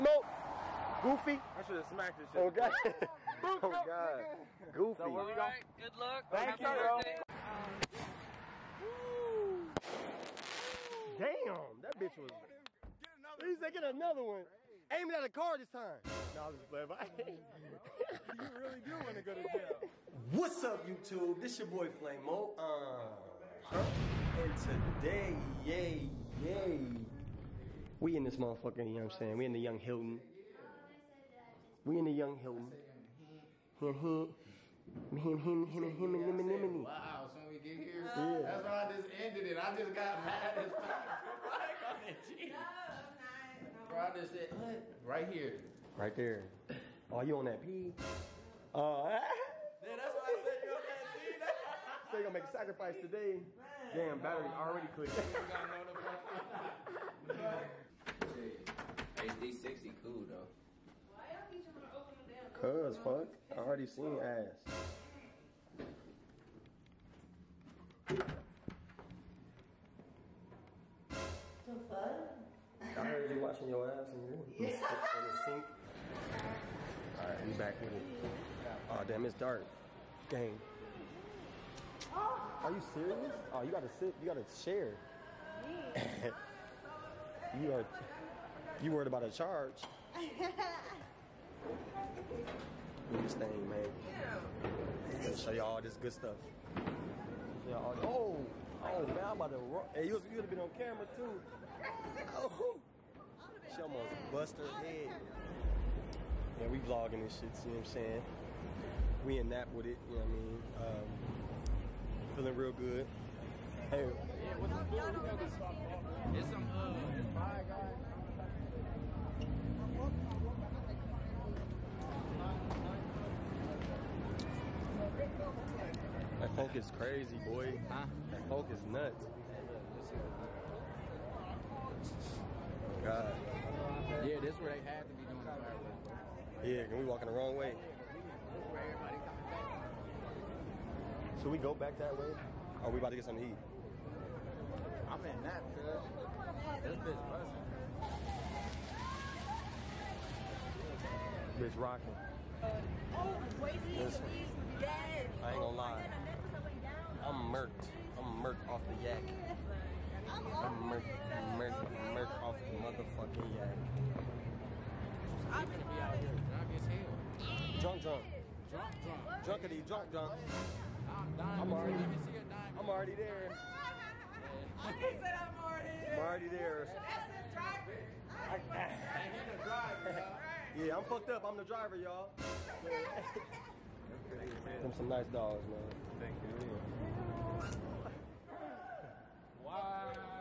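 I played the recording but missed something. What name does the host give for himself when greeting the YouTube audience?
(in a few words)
Flame.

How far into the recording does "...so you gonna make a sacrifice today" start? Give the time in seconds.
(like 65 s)
52 s.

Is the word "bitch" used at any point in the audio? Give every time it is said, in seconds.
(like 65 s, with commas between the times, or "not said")
11 s, 146 s, 151 s.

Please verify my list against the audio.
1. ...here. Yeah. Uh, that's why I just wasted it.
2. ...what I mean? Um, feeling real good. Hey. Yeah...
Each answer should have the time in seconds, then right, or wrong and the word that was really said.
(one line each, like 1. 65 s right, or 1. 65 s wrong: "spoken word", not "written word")
1. 37 s wrong: "ended", not "wasted"
2. 110 s right.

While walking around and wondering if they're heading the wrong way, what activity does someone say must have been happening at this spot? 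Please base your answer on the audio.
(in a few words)
fireworks.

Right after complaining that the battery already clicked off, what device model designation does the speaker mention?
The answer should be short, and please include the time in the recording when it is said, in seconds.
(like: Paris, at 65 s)
HD60, at 59 s.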